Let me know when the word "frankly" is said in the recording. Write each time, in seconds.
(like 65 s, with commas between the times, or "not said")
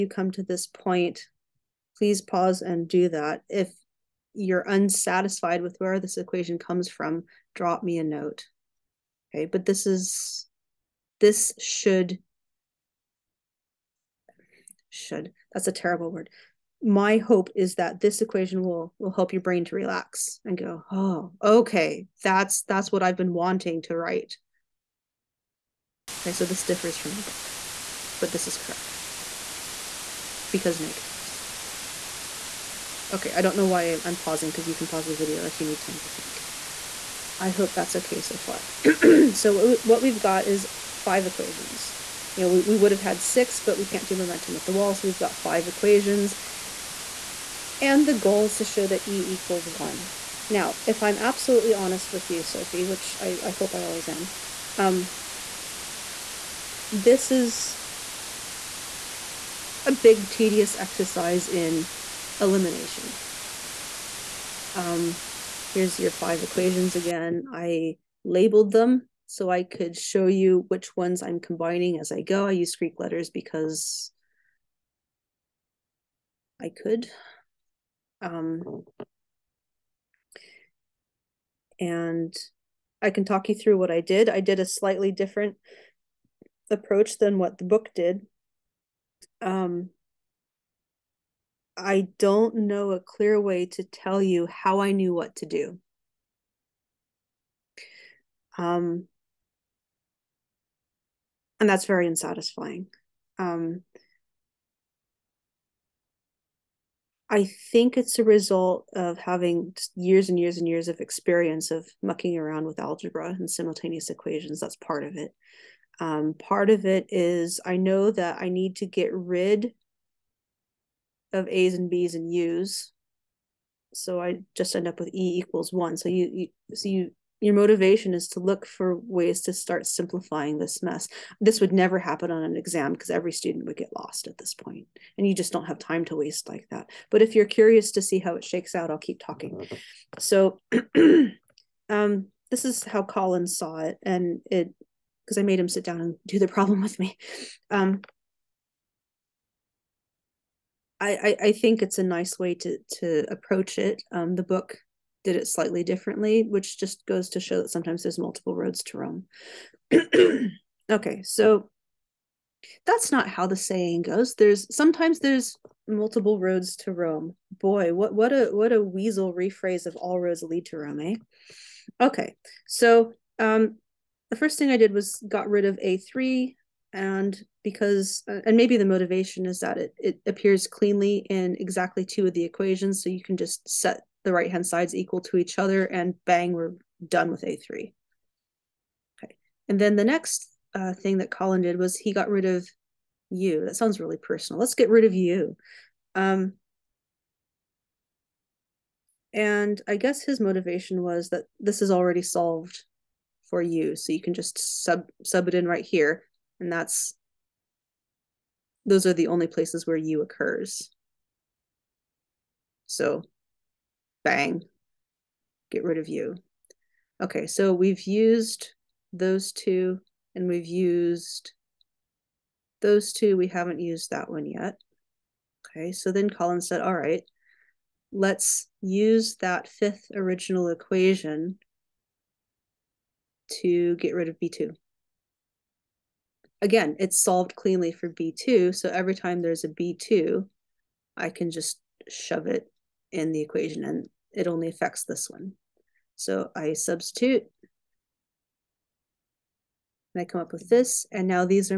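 not said.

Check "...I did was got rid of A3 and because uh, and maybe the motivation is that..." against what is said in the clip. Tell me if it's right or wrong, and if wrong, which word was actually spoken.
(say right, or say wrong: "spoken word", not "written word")
right.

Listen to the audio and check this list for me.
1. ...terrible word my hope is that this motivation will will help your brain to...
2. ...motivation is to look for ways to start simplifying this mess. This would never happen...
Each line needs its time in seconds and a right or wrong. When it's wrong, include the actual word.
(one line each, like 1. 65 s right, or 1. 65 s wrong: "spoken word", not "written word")
1. 15 s wrong: "equation", not "motivation"
2. 127 s right.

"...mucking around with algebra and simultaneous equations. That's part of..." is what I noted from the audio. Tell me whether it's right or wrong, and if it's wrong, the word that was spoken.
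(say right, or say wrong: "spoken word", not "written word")
right.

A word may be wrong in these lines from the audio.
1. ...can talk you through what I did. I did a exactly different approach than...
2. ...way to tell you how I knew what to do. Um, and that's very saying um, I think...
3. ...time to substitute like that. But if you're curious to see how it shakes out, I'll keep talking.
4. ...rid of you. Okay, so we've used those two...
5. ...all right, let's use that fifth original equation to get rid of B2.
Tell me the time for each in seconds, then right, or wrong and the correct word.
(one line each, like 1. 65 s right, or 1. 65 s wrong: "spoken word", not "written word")
1. 83 s wrong: "slightly", not "exactly"
2. 93 s wrong: "unsatisfying", not "saying"
3. 135 s wrong: "waste", not "substitute"
4. 215 s right
5. 226 s right.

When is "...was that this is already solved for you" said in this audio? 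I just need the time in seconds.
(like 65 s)
201 s.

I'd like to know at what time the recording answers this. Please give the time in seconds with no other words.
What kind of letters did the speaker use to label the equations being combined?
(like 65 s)
72 s.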